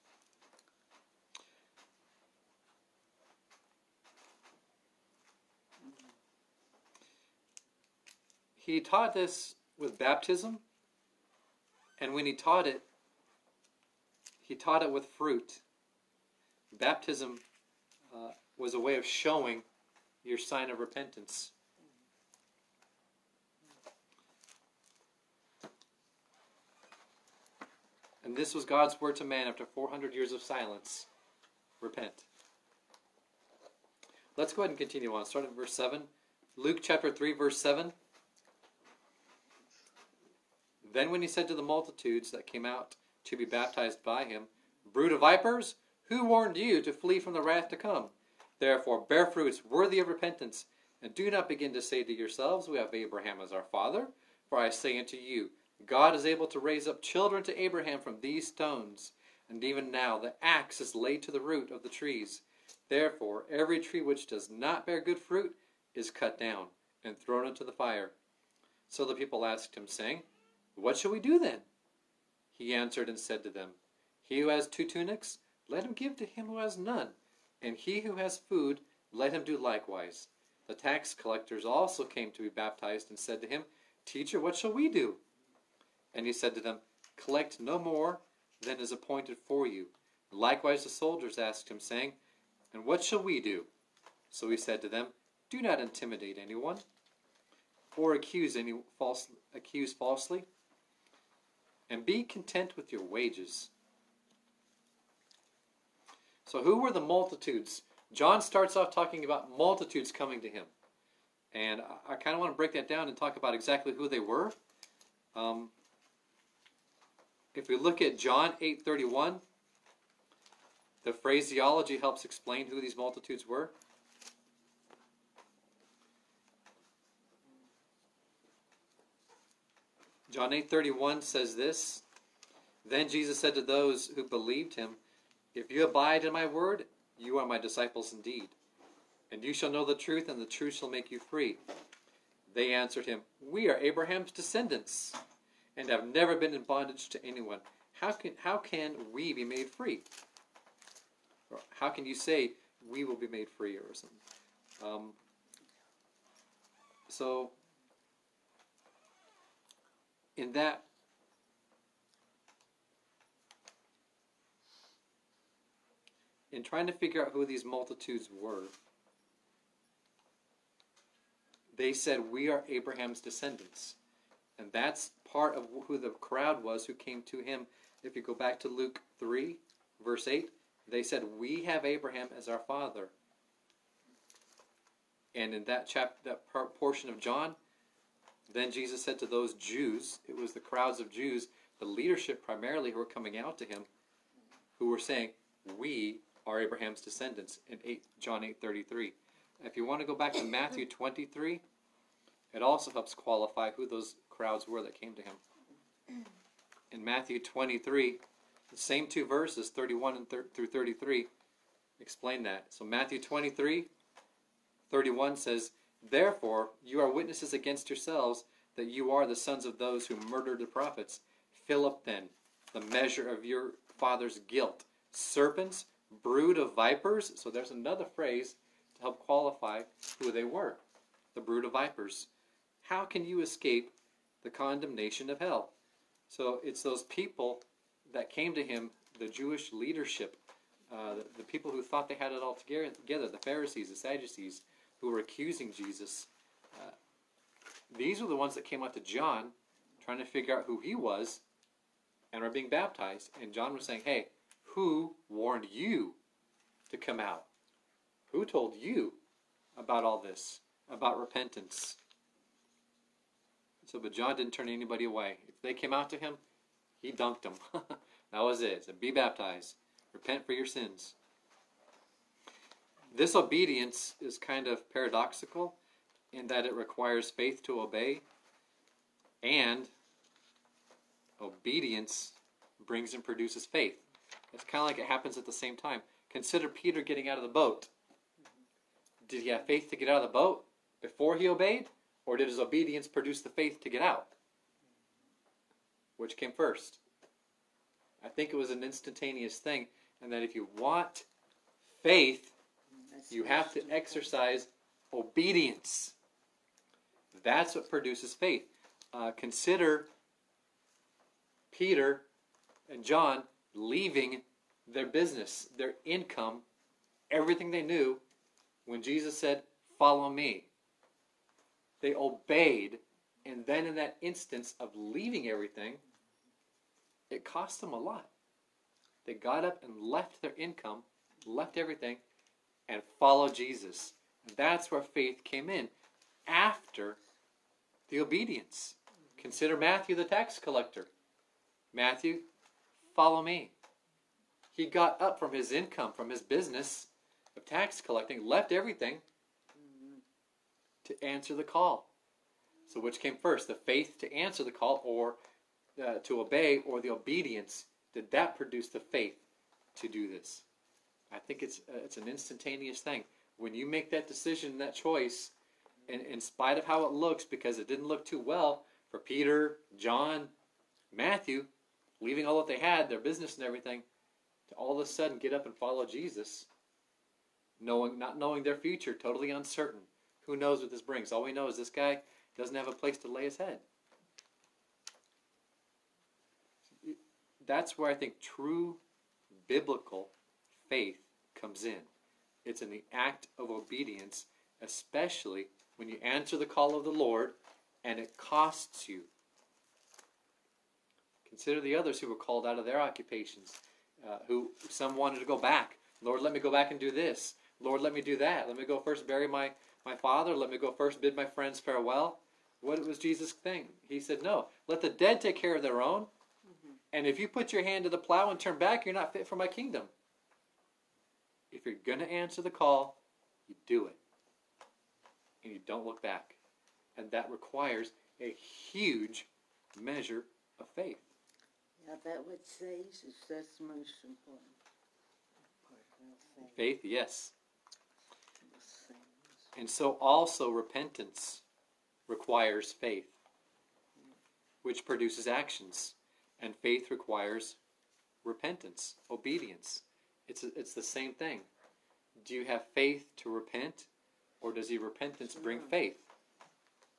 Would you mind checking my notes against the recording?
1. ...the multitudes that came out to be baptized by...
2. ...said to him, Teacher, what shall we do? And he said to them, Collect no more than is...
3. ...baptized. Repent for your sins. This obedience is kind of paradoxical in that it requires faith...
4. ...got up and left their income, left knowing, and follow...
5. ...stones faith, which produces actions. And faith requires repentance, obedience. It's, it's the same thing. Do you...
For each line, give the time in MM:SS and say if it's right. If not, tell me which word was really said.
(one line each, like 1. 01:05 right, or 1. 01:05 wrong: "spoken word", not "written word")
1. 00:41 right
2. 01:23 right
3. 04:29 right
4. 05:29 wrong: "everything", not "knowing"
5. 07:22 wrong: "requires", not "stones".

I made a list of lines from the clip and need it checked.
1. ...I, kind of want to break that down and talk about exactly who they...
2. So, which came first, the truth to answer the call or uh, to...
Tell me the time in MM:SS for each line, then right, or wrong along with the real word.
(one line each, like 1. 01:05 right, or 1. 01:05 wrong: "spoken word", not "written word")
1. 01:52 right
2. 05:52 wrong: "faith", not "truth".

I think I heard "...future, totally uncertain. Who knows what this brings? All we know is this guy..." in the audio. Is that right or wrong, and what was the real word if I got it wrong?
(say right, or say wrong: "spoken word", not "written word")
right.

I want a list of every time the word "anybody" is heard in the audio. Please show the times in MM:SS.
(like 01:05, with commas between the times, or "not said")
04:24.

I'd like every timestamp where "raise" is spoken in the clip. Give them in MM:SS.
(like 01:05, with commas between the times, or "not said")
00:56.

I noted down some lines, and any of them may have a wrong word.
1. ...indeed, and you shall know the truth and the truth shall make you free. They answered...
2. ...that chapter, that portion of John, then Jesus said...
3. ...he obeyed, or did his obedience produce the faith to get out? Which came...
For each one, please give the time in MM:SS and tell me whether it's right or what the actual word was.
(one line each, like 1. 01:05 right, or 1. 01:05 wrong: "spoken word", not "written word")
1. 02:18 right
2. 03:05 right
3. 04:51 right.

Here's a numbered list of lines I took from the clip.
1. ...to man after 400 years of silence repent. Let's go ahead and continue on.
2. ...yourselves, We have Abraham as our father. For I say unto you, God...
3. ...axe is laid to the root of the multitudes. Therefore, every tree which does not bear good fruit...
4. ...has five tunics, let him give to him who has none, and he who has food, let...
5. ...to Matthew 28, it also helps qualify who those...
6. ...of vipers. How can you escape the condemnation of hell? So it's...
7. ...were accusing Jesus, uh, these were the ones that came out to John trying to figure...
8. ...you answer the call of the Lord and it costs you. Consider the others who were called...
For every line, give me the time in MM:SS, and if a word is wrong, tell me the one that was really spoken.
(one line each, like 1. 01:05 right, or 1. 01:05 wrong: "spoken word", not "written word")
1. 00:29 right
2. 00:52 right
3. 01:00 wrong: "trees", not "multitudes"
4. 01:14 wrong: "two", not "five"
5. 03:20 wrong: "23", not "28"
6. 03:51 right
7. 04:05 right
8. 06:36 right.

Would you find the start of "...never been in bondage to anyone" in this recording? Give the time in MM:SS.
02:26.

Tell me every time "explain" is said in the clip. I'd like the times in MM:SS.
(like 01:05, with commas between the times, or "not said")
02:02, 03:31.